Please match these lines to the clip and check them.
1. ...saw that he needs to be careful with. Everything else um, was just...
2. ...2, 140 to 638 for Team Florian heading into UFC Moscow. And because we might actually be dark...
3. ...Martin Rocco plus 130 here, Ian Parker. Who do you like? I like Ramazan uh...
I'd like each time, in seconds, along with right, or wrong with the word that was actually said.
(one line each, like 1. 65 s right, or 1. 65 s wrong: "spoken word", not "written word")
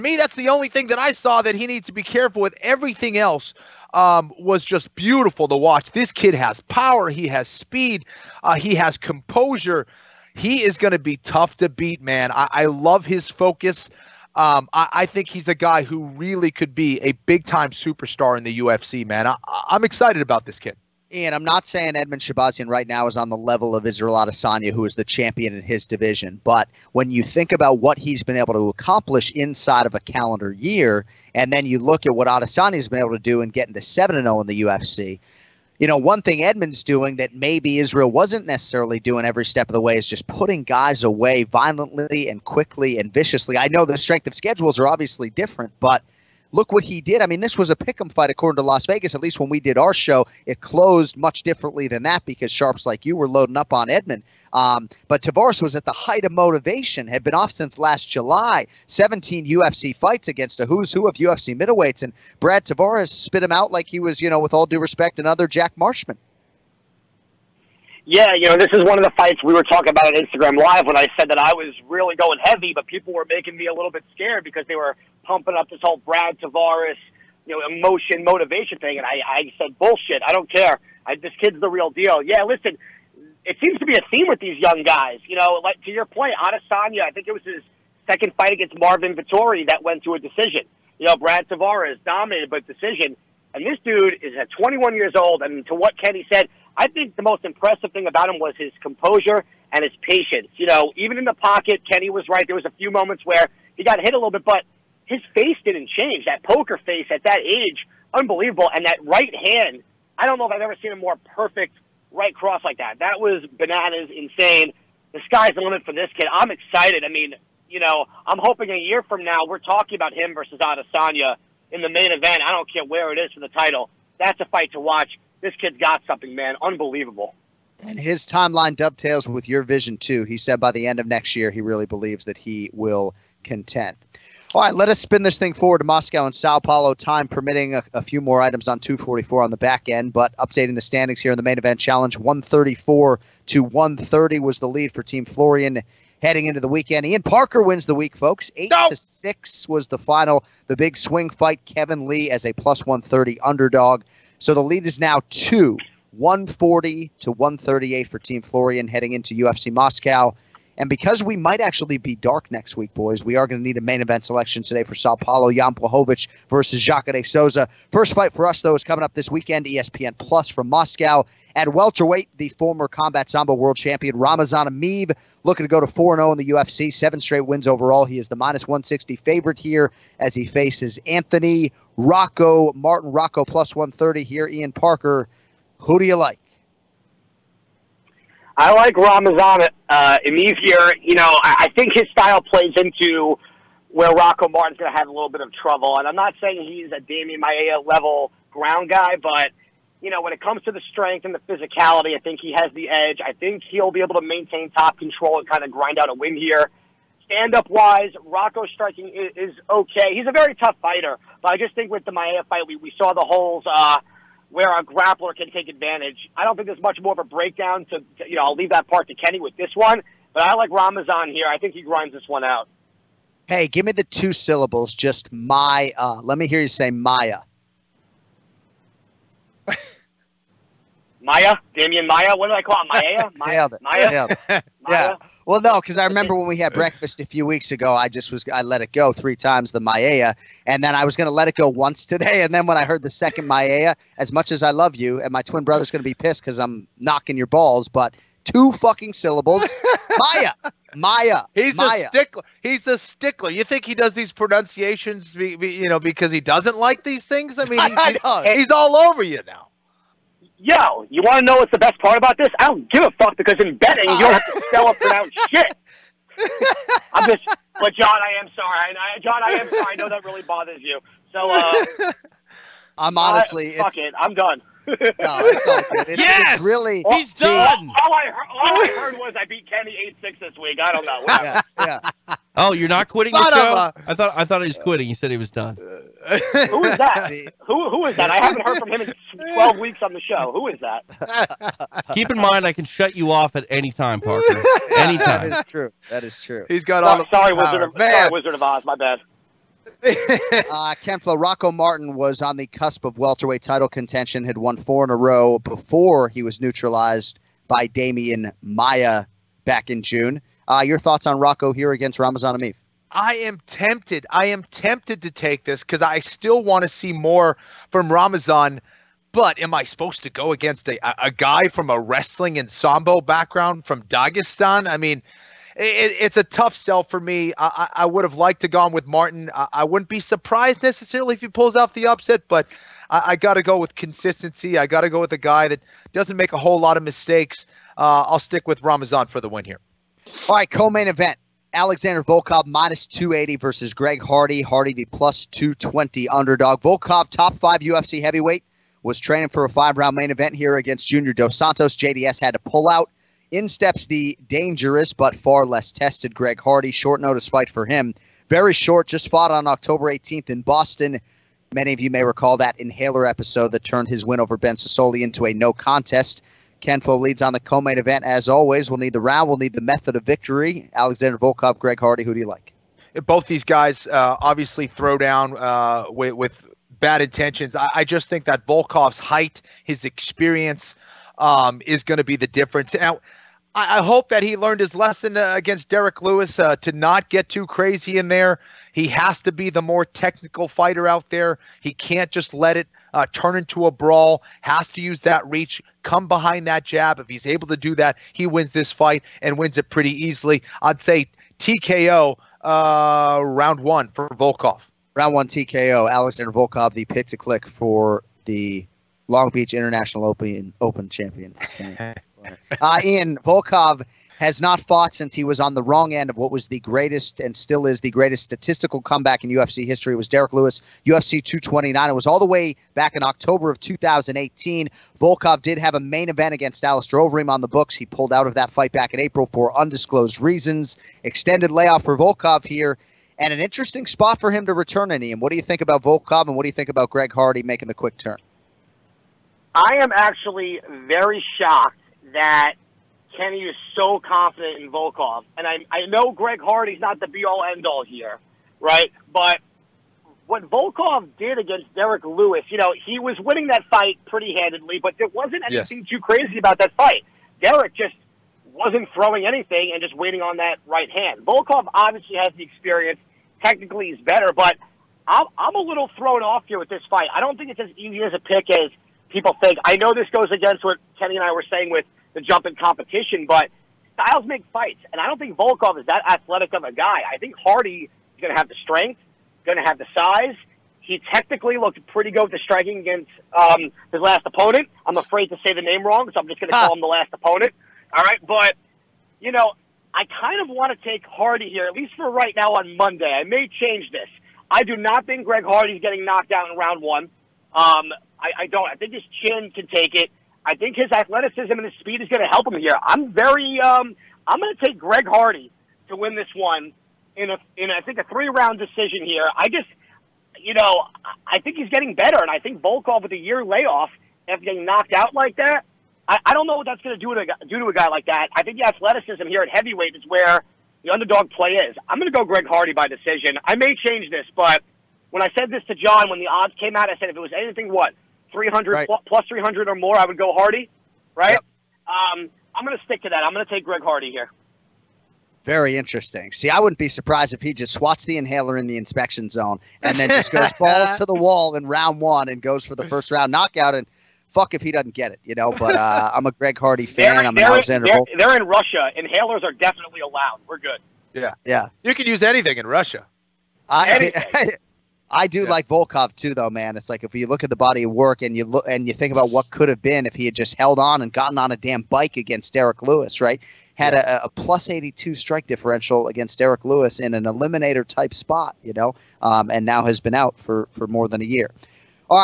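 1. 1 s right
2. 155 s wrong: "138", not "638"
3. 182 s right.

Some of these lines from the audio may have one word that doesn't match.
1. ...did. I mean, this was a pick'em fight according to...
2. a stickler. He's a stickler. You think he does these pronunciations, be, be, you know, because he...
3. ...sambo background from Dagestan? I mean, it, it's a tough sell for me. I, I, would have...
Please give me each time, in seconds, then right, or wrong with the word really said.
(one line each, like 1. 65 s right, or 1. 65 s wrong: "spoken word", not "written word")
1. 47 s right
2. 252 s right
3. 322 s right.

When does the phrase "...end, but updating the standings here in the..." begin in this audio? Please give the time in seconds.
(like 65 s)
139 s.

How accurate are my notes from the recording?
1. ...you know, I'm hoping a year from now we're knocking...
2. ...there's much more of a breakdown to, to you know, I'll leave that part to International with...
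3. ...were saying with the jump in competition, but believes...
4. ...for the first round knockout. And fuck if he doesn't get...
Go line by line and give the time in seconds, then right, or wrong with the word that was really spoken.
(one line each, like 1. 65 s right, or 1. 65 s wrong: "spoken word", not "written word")
1. 117 s wrong: "talking", not "knocking"
2. 216 s wrong: "Kenny", not "International"
3. 471 s wrong: "styles", not "believes"
4. 542 s right.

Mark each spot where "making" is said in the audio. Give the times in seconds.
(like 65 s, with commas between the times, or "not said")
73 s, 437 s.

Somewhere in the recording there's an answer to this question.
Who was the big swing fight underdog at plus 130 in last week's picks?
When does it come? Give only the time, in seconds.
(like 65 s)
151 s.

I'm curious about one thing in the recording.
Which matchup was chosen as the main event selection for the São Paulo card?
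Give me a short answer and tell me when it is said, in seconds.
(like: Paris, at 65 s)
Jan Blachowicz versus Jacare Souza, at 165 s.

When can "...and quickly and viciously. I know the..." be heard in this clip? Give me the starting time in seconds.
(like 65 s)
42 s.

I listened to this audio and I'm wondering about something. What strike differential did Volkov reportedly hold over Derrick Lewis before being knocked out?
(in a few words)
plus 82.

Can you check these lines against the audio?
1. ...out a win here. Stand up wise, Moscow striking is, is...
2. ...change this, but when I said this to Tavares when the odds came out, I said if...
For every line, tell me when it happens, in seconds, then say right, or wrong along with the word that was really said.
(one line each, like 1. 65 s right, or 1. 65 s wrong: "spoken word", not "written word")
1. 205 s wrong: "Rocco", not "Moscow"
2. 524 s wrong: "Jon", not "Tavares".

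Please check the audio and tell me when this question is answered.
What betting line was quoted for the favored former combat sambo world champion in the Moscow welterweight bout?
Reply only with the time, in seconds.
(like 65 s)
178 s.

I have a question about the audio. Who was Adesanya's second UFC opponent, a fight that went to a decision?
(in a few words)
Marvin Vettori.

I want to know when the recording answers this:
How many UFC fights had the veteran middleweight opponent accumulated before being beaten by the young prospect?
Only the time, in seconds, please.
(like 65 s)
58 s.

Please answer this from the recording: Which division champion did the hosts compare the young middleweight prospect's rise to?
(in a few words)
Israel Adesanya.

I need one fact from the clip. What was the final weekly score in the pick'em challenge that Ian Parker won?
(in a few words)
8 to 6.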